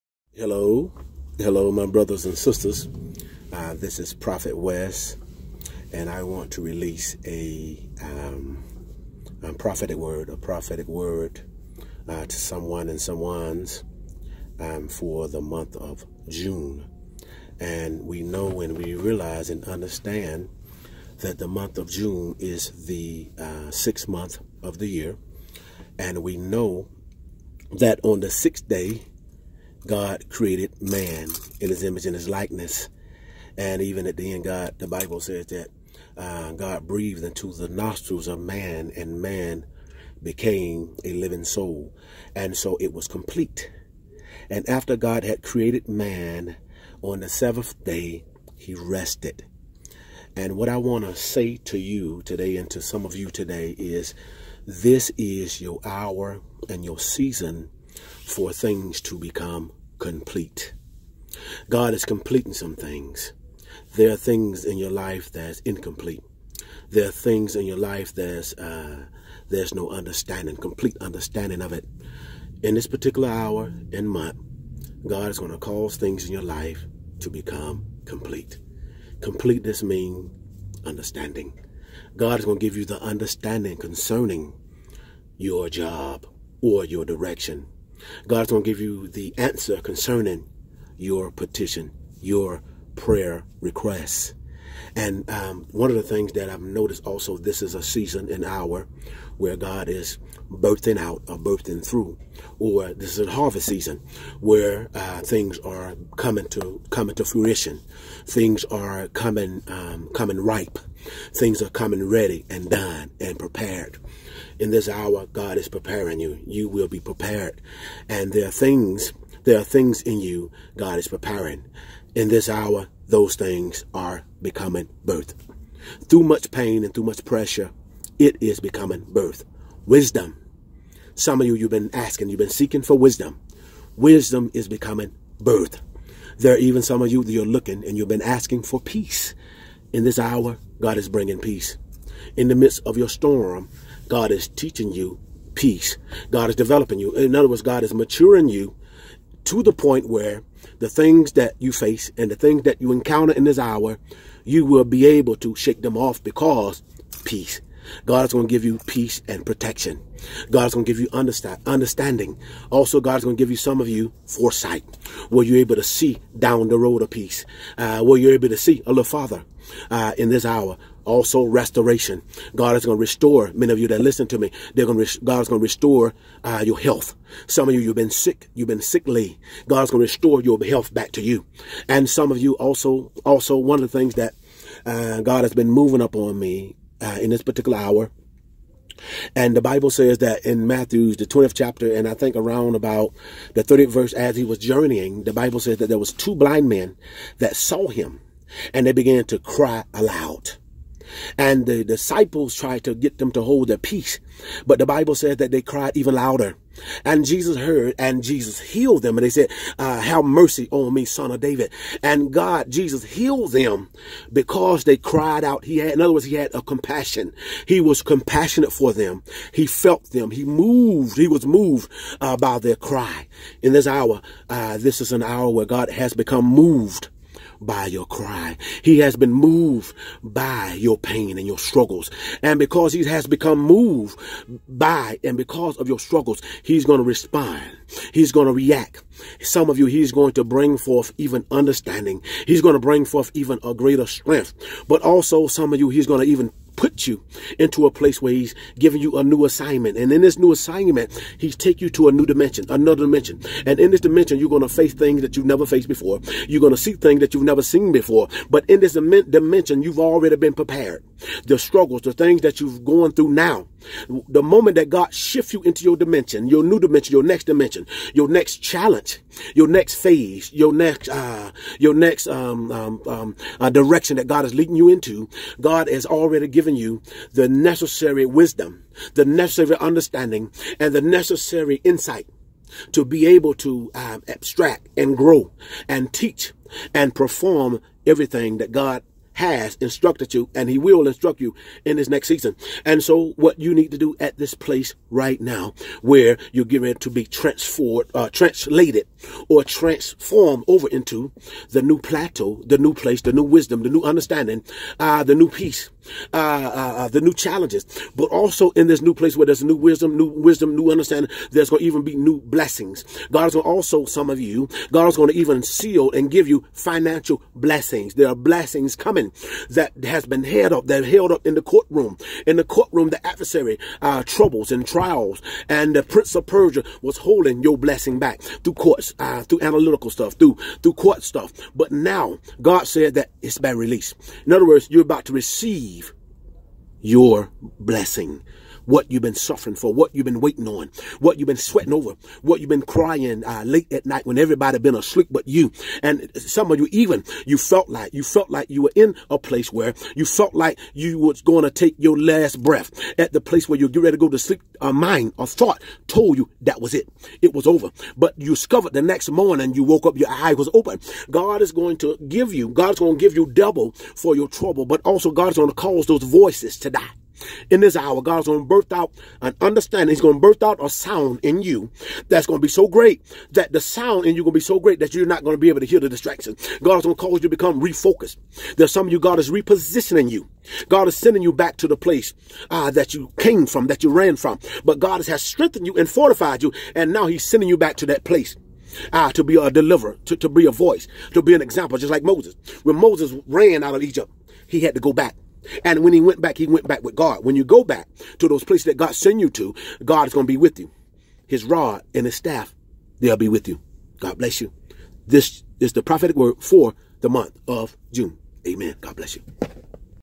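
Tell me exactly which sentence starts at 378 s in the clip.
There's some of you, God is repositioning you.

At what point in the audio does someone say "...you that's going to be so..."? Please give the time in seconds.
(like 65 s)
371 s.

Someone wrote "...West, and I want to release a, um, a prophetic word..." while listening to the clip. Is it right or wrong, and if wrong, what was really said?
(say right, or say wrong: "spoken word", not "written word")
right.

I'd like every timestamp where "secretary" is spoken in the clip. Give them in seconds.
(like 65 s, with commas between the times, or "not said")
not said.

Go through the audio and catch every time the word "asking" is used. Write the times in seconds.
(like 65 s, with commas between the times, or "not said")
131 s, 138 s.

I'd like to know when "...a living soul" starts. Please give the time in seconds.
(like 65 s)
41 s.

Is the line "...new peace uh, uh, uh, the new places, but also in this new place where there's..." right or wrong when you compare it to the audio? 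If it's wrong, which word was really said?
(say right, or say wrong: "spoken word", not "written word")
wrong: "challenges", not "places".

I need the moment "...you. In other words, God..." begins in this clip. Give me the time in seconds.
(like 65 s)
146 s.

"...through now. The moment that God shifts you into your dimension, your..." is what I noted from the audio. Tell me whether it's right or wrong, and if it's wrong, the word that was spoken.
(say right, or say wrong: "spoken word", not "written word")
right.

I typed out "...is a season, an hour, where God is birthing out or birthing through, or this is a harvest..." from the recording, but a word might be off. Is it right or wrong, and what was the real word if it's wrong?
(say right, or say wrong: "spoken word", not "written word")
right.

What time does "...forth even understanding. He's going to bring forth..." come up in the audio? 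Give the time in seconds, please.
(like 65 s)
240 s.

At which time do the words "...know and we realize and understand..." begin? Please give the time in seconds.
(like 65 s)
18 s.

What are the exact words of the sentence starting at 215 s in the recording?
He had, in other words, he had a compassion.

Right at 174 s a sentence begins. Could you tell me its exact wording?
They're going to God is going to restore uh, your health.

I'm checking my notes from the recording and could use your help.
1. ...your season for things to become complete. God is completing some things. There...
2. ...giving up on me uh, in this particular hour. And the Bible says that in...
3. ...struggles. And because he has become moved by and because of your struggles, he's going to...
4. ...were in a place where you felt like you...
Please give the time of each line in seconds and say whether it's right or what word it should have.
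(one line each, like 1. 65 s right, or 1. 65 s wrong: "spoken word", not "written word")
1. 56 s right
2. 185 s wrong: "moving", not "giving"
3. 231 s right
4. 348 s right.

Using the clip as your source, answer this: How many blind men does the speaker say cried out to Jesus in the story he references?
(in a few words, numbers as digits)
2.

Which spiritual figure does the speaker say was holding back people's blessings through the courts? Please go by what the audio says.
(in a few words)
prince of Persia.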